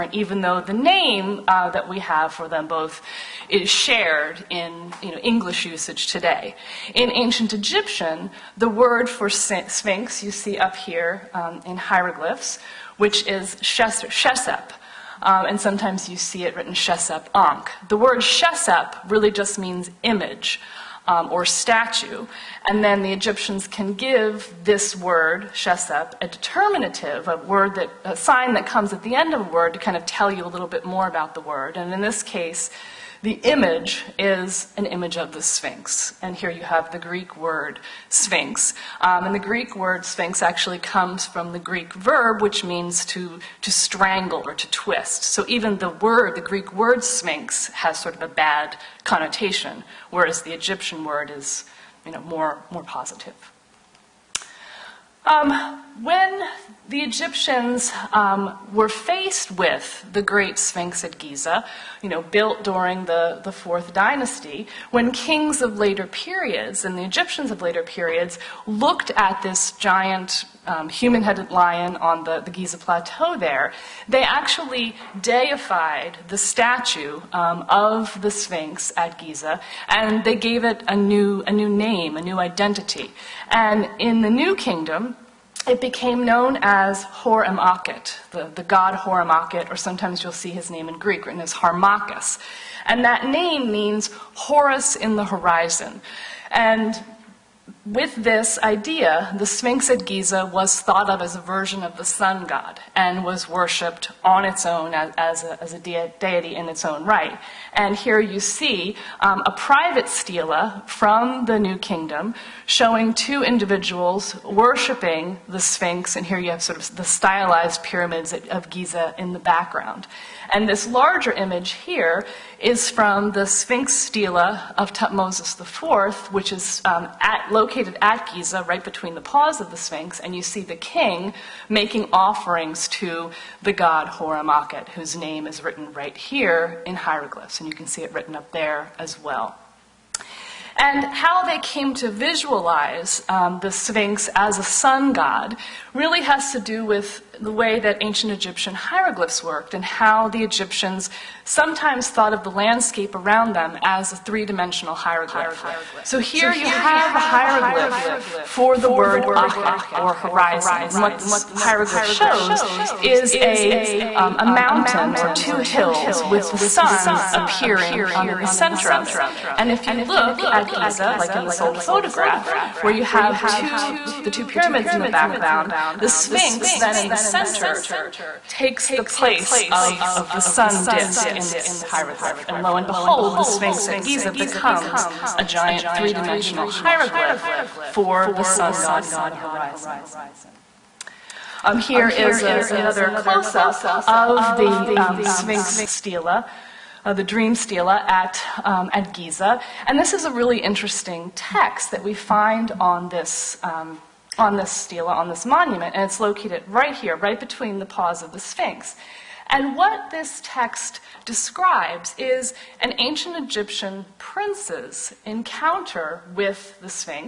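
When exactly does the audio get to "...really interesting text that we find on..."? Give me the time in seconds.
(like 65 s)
200 s.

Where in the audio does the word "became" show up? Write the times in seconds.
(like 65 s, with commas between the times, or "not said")
85 s.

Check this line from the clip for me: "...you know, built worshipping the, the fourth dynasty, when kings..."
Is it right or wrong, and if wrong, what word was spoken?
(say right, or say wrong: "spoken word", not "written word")
wrong: "during", not "worshipping".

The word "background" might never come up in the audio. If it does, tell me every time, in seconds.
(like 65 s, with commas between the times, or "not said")
119 s, 175 s.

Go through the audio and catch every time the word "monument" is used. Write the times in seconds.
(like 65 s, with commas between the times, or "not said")
205 s.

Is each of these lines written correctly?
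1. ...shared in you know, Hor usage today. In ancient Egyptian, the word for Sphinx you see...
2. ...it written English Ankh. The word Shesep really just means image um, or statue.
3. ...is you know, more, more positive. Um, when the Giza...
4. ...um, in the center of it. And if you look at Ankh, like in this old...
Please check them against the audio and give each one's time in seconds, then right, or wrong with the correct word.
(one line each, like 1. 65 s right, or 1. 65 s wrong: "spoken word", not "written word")
1. 3 s wrong: "English", not "Hor"
2. 16 s wrong: "Shesep", not "English"
3. 51 s wrong: "Egyptians", not "Giza"
4. 168 s wrong: "Giza", not "Ankh".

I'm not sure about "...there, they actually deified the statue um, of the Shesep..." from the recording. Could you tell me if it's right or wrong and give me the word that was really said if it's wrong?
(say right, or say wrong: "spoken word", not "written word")
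wrong: "Sphinx", not "Shesep".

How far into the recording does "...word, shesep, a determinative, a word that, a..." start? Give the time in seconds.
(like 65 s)
24 s.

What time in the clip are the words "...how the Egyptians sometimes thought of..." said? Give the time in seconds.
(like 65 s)
149 s.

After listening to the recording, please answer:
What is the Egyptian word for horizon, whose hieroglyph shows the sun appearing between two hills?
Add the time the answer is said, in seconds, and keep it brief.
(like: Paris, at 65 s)
achet, at 159 s.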